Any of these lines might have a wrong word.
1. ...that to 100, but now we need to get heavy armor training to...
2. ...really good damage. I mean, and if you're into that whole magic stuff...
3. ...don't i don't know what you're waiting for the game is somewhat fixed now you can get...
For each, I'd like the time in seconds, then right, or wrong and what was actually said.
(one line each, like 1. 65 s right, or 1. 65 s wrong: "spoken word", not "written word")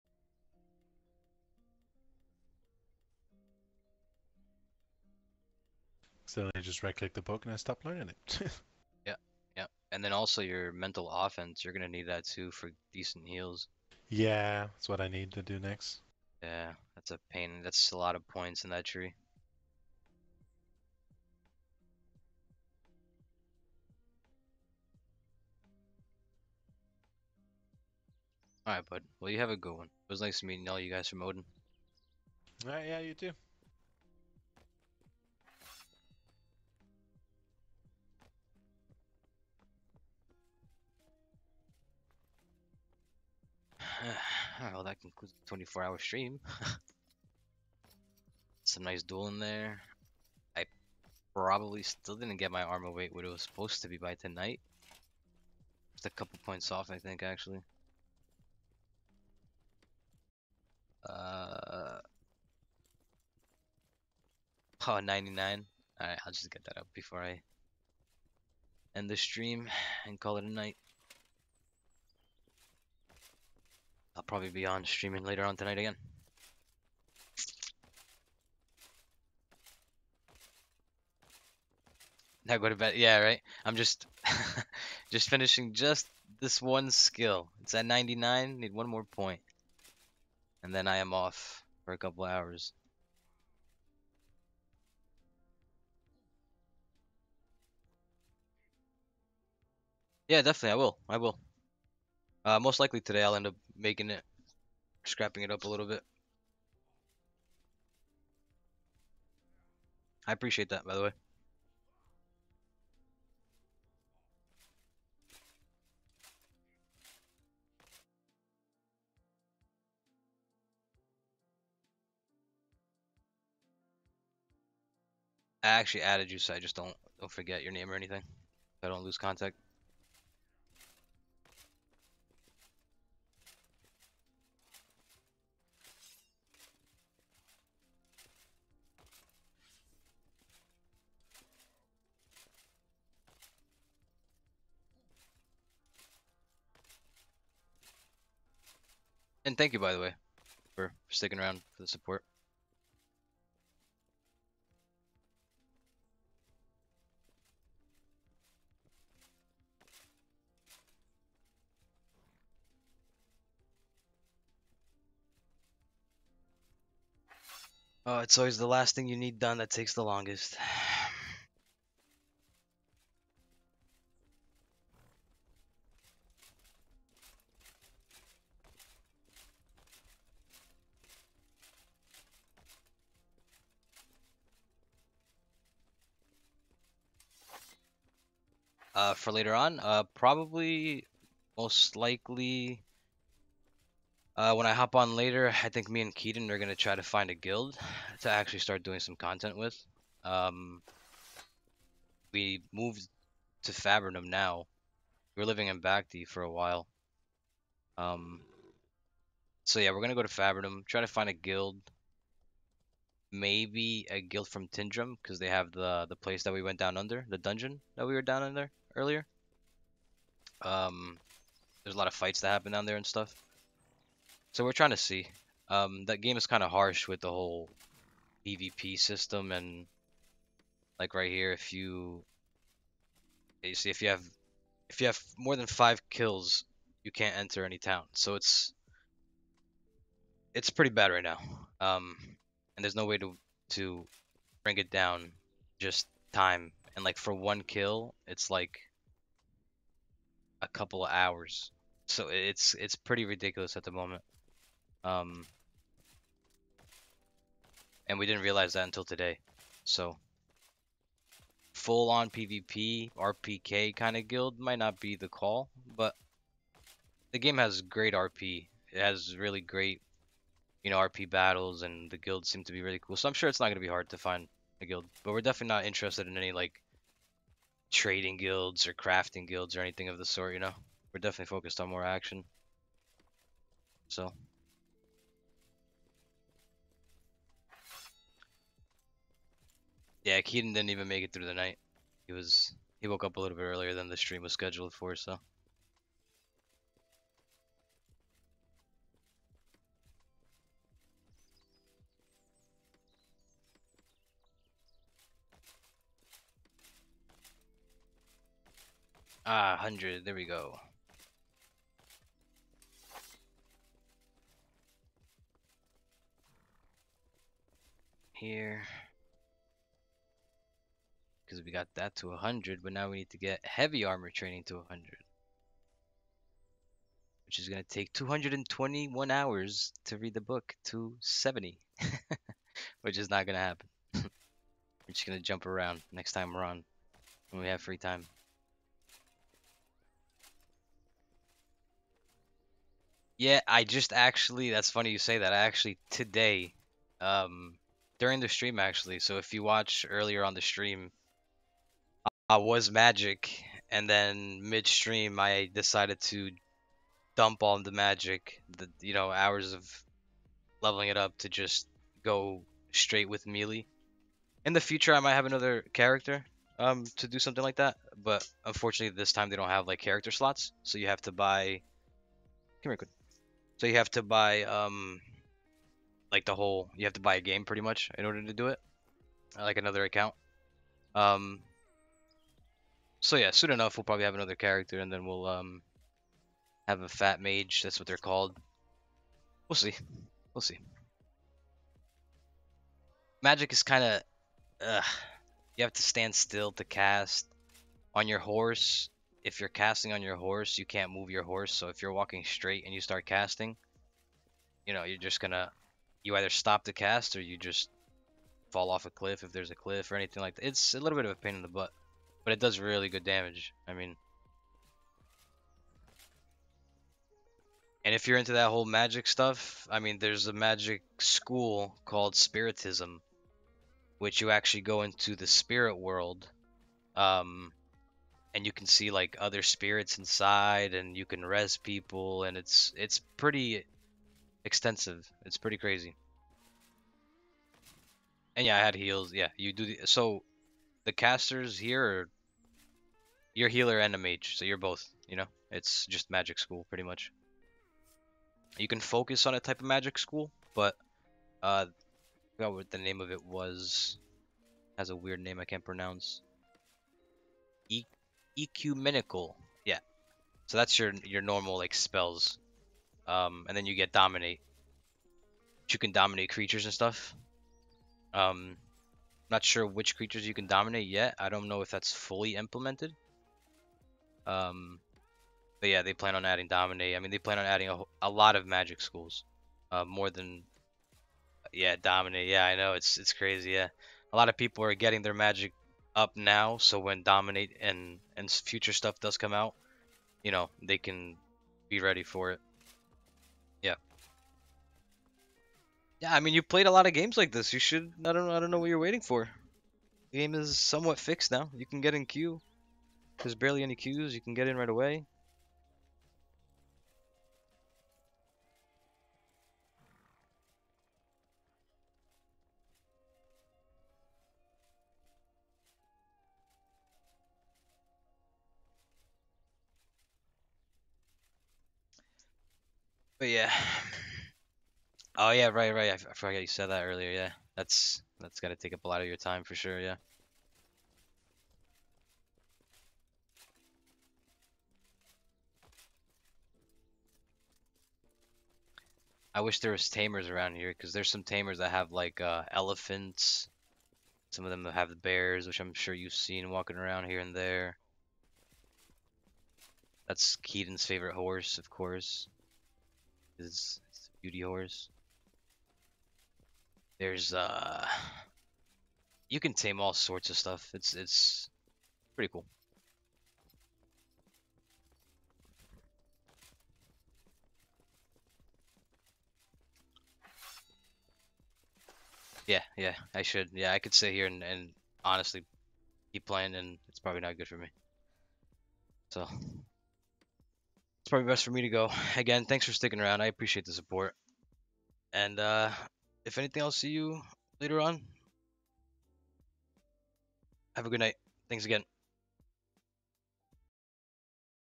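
1. 321 s right
2. 412 s right
3. 498 s right.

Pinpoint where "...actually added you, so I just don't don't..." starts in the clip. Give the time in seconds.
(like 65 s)
125 s.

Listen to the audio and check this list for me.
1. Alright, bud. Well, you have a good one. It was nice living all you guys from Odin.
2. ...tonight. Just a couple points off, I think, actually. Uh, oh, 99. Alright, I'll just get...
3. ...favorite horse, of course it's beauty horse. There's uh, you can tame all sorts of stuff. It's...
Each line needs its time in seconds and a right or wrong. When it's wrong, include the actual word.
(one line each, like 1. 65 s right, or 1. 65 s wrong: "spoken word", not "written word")
1. 28 s wrong: "meeting", not "living"
2. 54 s right
3. 551 s right.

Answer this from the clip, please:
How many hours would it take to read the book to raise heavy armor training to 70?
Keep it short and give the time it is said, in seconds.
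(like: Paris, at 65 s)
221, at 328 s.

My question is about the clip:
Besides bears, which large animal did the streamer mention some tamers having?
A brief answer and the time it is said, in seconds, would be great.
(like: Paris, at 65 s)
elephants, at 542 s.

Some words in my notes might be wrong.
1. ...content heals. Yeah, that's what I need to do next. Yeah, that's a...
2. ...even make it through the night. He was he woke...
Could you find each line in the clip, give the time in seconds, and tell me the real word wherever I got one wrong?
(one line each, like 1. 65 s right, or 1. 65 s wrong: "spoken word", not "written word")
1. 12 s wrong: "decent", not "content"
2. 290 s right.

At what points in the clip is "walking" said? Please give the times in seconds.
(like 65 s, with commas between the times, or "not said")
402 s, 546 s.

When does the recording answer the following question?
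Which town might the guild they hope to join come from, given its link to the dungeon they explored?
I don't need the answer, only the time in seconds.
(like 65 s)
214 s.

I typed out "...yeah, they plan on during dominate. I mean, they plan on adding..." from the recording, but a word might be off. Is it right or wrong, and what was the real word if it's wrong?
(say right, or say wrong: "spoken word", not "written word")
wrong: "adding", not "during".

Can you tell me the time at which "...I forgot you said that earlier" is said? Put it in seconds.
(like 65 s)
526 s.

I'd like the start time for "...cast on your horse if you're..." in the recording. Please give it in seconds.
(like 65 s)
396 s.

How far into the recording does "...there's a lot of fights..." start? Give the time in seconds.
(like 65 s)
221 s.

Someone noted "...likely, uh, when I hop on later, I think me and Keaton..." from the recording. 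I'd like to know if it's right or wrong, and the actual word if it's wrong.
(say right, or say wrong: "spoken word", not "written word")
right.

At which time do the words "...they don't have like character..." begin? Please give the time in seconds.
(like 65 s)
369 s.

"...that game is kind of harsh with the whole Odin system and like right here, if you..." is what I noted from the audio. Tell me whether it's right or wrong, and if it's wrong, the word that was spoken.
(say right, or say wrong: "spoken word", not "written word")
wrong: "PvP", not "Odin".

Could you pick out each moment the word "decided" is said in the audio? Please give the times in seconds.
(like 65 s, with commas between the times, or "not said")
355 s.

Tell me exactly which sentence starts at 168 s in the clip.
Oh, it's always the last thing you need done that takes the longest.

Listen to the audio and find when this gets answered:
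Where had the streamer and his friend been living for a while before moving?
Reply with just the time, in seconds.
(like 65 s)
205 s.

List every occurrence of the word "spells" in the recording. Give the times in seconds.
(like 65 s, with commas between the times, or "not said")
461 s.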